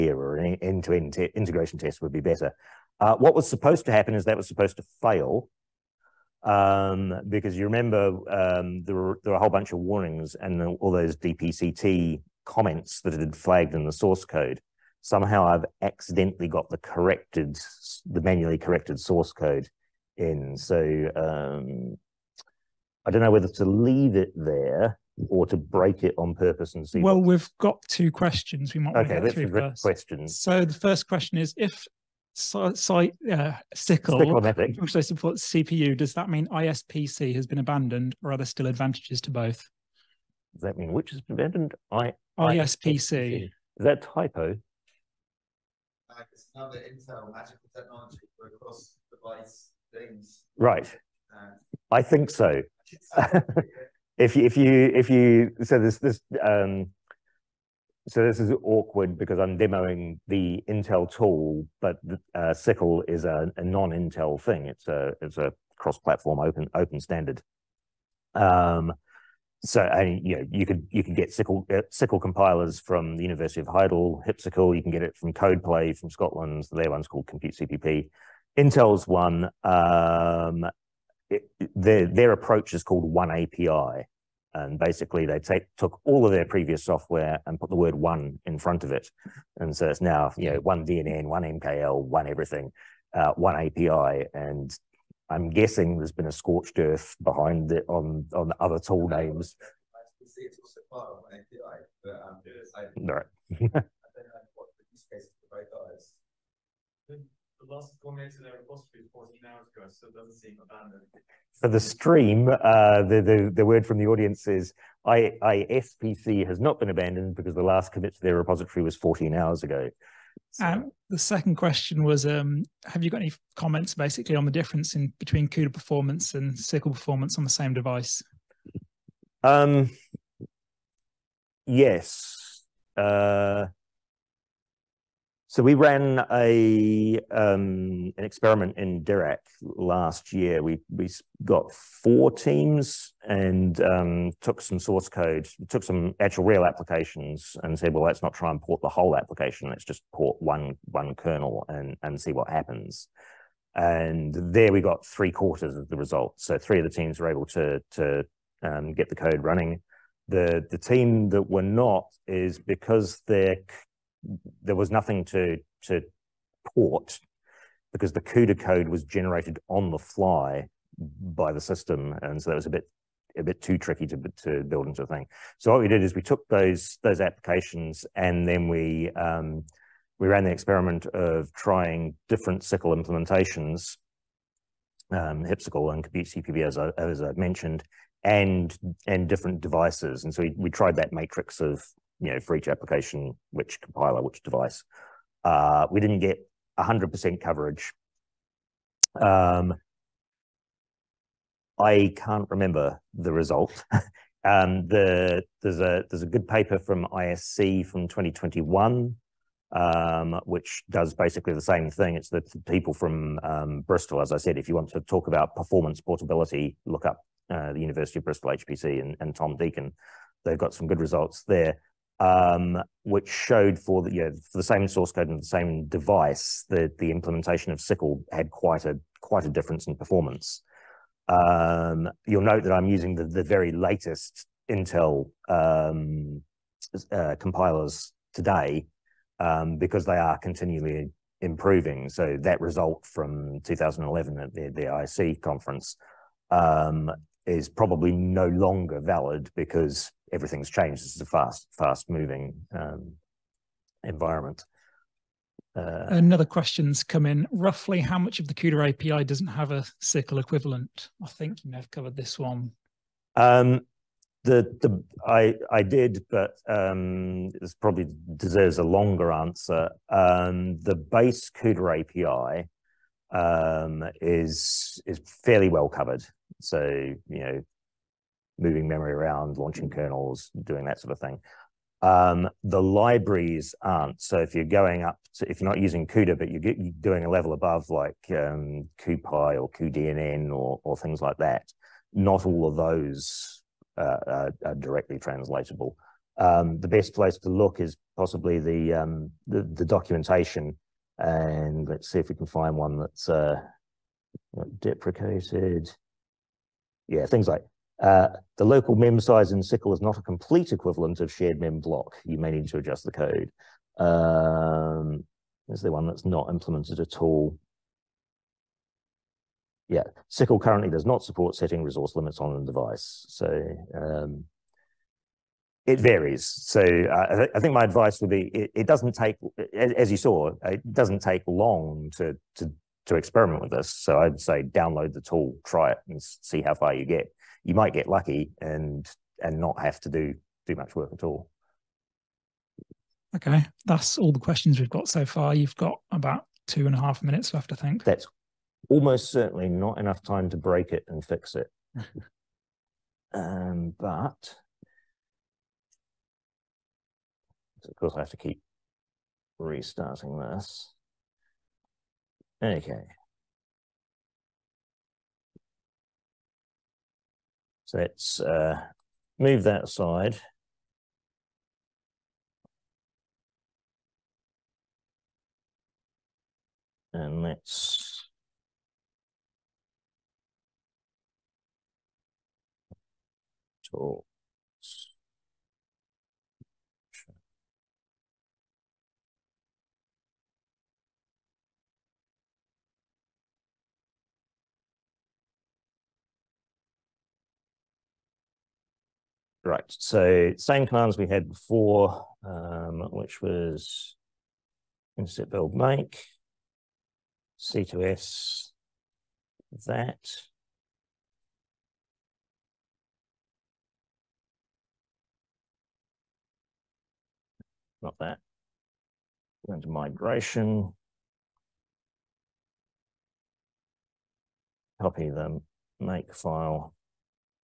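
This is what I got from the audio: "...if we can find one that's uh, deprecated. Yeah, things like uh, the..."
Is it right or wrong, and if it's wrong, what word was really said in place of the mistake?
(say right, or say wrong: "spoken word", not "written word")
right.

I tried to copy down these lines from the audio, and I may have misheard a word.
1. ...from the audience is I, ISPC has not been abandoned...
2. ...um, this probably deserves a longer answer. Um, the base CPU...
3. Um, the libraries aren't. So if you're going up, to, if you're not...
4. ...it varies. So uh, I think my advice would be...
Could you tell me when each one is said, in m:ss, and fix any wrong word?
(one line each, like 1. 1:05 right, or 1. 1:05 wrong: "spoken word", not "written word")
1. 1:53 right
2. 4:26 wrong: "CUDA", not "CPU"
3. 4:42 right
4. 5:25 right.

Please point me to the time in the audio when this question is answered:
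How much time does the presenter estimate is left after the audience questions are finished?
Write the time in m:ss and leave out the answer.
5:46.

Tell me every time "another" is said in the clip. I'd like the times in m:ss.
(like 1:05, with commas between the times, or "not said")
0:46, 4:16.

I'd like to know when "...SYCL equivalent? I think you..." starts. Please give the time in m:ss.
4:20.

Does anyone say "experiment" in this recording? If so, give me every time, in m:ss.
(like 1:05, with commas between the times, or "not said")
2:18, 3:00, 5:33.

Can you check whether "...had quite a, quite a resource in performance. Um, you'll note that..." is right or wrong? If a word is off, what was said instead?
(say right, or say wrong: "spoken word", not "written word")
wrong: "difference", not "resource".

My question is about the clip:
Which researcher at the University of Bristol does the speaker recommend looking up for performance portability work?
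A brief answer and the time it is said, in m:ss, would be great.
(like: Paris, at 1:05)
Tom Deakin, at 3:39.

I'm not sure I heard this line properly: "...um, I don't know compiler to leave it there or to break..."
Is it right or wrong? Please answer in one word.
wrong.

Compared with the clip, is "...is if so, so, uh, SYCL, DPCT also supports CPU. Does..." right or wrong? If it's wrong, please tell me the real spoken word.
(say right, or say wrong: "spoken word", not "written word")
wrong: "SYCL", not "DPCT".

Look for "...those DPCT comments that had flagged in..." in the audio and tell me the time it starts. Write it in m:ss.
0:10.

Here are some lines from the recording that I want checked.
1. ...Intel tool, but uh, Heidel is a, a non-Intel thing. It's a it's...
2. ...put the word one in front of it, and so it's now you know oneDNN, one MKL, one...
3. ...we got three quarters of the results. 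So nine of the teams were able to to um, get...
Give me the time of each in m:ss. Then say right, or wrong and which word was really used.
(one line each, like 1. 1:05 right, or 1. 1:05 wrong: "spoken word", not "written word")
1. 1:00 wrong: "SYCL", not "Heidel"
2. 1:27 right
3. 2:34 wrong: "three", not "nine".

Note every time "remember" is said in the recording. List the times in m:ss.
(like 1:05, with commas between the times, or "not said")
0:07, 3:22.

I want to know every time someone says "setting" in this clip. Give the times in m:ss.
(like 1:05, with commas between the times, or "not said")
5:21.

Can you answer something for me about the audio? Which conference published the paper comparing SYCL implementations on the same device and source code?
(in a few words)
ISC.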